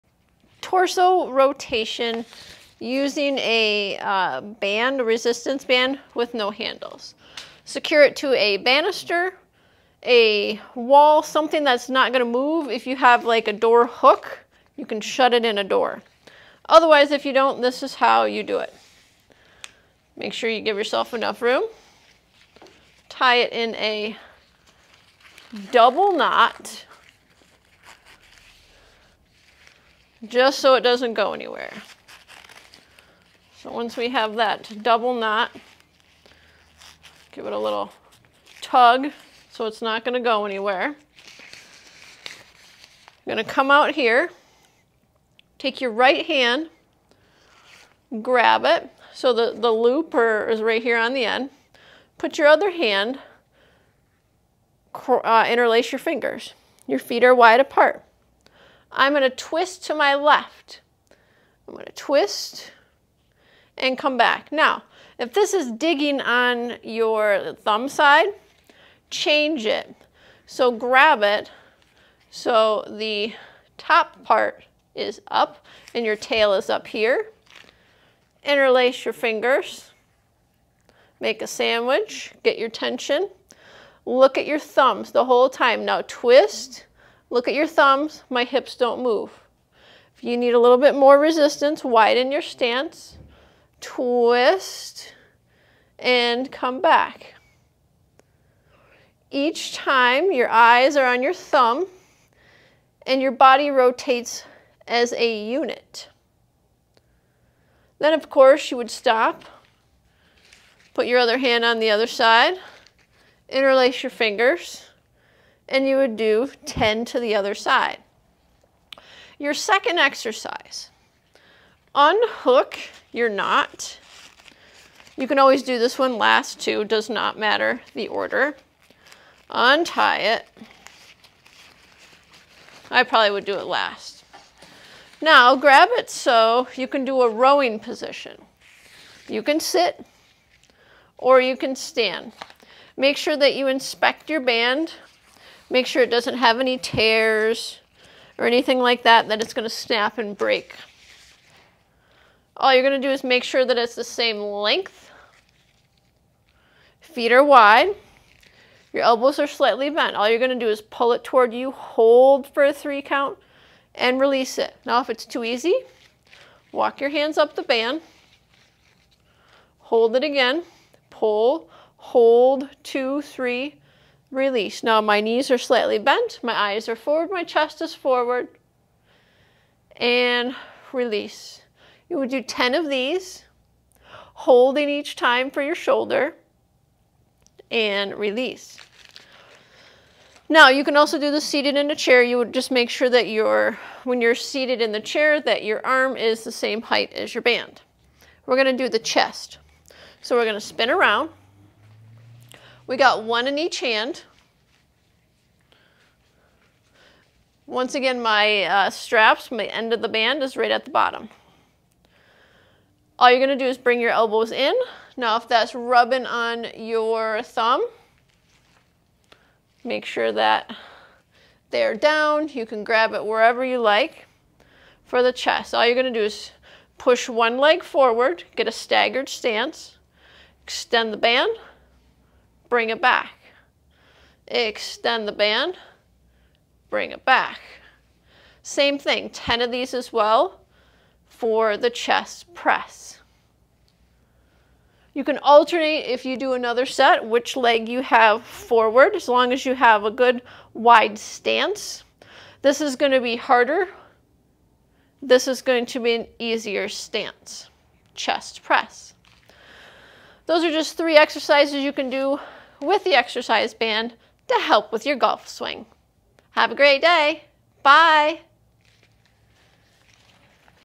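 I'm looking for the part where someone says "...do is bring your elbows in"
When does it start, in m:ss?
3:33.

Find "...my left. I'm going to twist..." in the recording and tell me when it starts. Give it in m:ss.
0:59.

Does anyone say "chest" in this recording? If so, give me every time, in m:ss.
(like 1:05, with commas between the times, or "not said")
2:57, 3:18, 3:45, 4:01, 4:18.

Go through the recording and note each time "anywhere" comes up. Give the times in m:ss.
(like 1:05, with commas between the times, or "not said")
0:31, 0:40.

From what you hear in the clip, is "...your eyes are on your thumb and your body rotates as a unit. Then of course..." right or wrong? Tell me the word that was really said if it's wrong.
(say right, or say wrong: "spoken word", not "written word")
right.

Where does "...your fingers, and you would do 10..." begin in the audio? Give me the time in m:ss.
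1:54.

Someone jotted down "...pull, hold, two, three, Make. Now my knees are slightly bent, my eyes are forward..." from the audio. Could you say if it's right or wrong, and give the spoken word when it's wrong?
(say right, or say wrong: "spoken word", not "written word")
wrong: "Release", not "Make".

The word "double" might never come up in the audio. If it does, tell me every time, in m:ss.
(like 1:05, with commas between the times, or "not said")
0:25, 0:34.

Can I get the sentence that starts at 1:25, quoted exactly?
Now twist Look at your thumbs, my hips don't move.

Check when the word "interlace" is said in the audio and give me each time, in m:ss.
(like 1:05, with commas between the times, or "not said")
0:55, 1:18, 1:53.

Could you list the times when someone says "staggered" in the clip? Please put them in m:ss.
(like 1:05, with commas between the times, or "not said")
3:48.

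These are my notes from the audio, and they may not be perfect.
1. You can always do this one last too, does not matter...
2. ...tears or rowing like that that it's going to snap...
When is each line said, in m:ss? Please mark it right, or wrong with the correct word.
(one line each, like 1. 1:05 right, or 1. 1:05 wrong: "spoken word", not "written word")
1. 2:05 right
2. 2:26 wrong: "anything", not "rowing".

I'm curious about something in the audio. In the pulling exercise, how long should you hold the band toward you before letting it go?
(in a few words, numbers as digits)
3 count.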